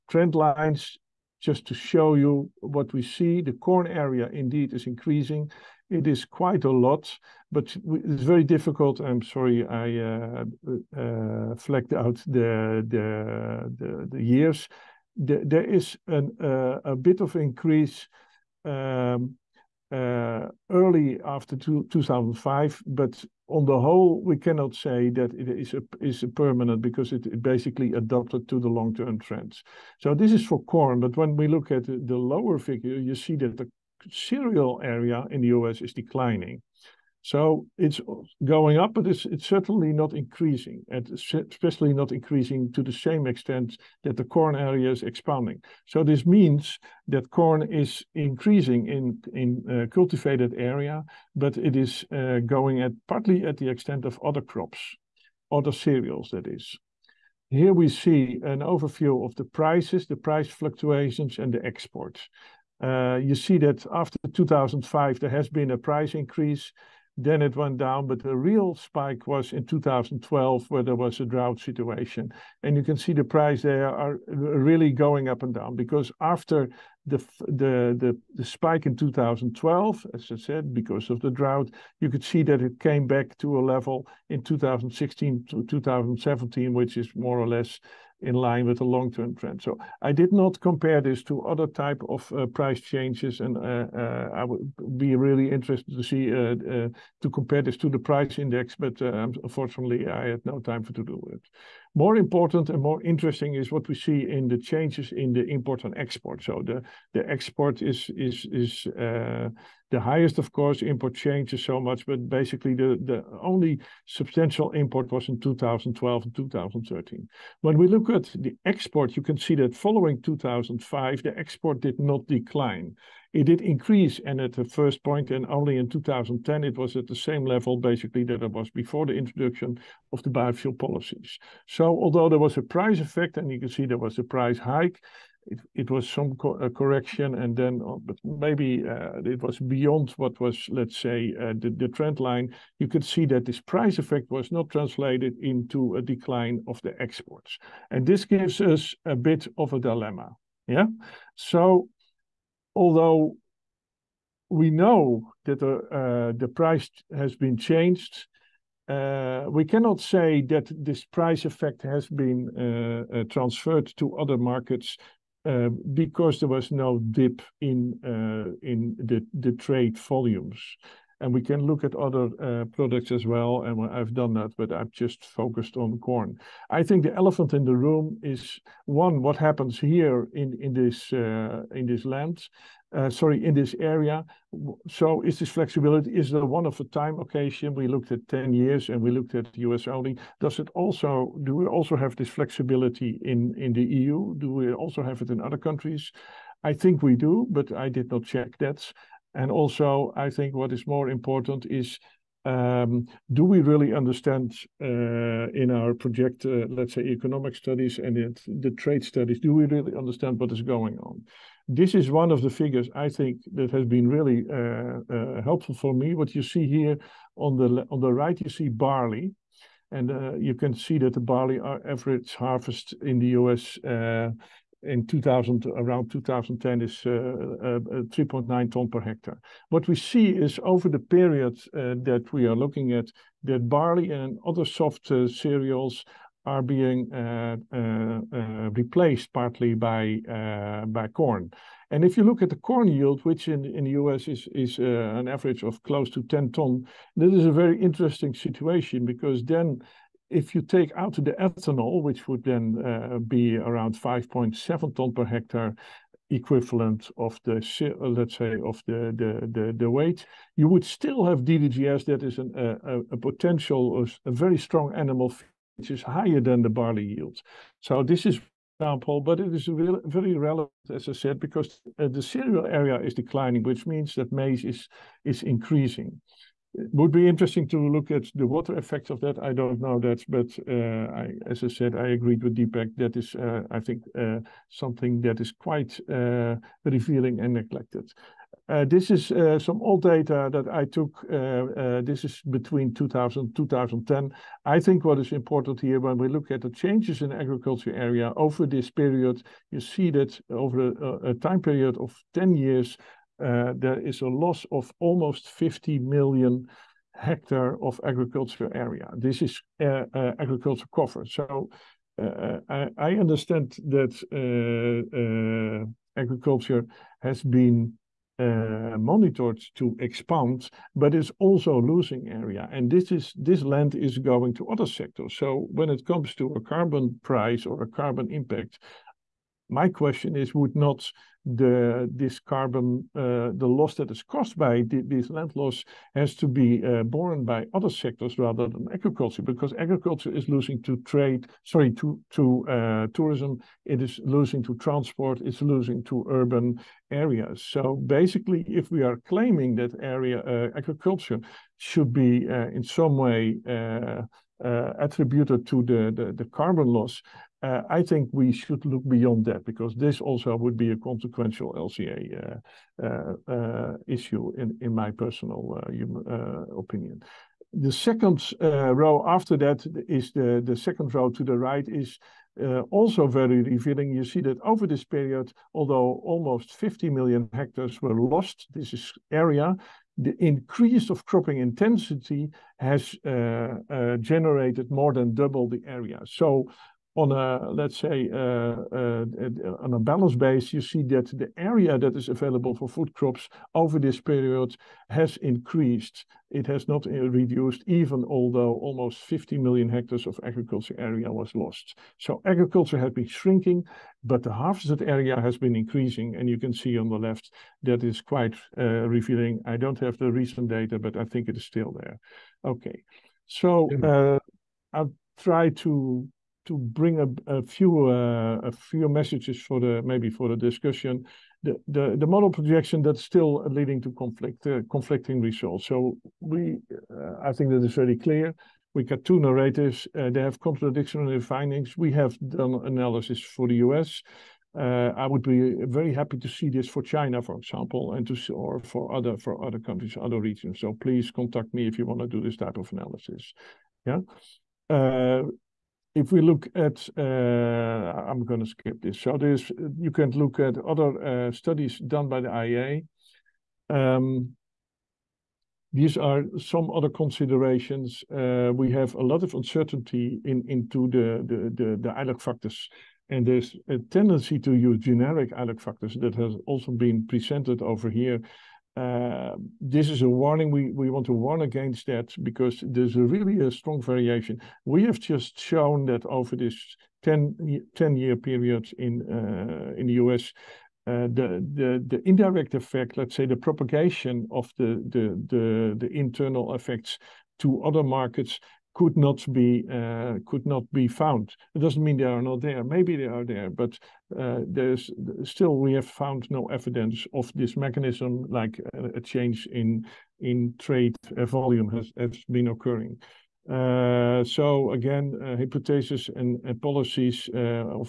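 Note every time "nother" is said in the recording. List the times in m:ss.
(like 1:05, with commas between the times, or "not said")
not said.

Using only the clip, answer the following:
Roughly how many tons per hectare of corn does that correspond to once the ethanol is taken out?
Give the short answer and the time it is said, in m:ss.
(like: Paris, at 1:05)
5.7 tons, at 4:13.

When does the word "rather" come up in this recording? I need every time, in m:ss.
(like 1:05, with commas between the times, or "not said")
5:38.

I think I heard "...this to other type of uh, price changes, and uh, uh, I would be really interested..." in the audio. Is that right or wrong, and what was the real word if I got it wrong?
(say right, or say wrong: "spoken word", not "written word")
right.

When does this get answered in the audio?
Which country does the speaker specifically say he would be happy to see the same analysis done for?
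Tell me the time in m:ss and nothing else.
7:17.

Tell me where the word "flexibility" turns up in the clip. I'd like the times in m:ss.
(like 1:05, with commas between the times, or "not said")
3:05, 3:12.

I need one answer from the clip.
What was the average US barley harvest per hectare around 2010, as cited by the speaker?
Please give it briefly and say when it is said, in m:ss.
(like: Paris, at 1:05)
3.9 tons, at 3:48.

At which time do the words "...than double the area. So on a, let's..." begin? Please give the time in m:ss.
6:25.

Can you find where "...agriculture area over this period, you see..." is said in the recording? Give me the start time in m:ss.
4:57.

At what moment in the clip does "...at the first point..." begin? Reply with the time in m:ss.
2:04.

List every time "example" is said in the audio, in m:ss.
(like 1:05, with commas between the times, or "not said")
4:28, 7:17.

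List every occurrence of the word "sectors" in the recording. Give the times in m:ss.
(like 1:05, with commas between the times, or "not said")
5:24, 5:37.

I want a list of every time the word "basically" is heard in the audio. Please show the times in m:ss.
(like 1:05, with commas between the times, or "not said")
0:27, 1:52, 2:07, 5:48.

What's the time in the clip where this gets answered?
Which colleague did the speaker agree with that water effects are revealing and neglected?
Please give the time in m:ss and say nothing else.
4:42.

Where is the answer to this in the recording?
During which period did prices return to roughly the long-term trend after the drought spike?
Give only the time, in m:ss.
1:24.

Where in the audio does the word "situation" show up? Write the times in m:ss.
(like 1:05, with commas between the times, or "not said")
1:11, 4:08.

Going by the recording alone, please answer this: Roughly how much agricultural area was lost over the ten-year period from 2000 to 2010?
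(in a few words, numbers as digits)
50 million hectares.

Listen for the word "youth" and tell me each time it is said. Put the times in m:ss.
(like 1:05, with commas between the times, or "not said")
not said.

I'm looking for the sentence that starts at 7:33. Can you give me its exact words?
Um, these are some other considerations.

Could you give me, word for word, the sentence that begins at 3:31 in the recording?
this is one of the figures I think that has been really uh, uh, helpful for me.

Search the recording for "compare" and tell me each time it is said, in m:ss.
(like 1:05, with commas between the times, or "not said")
1:30, 1:37.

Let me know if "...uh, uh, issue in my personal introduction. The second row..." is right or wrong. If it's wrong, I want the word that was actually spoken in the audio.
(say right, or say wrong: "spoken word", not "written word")
wrong: "opinion", not "introduction".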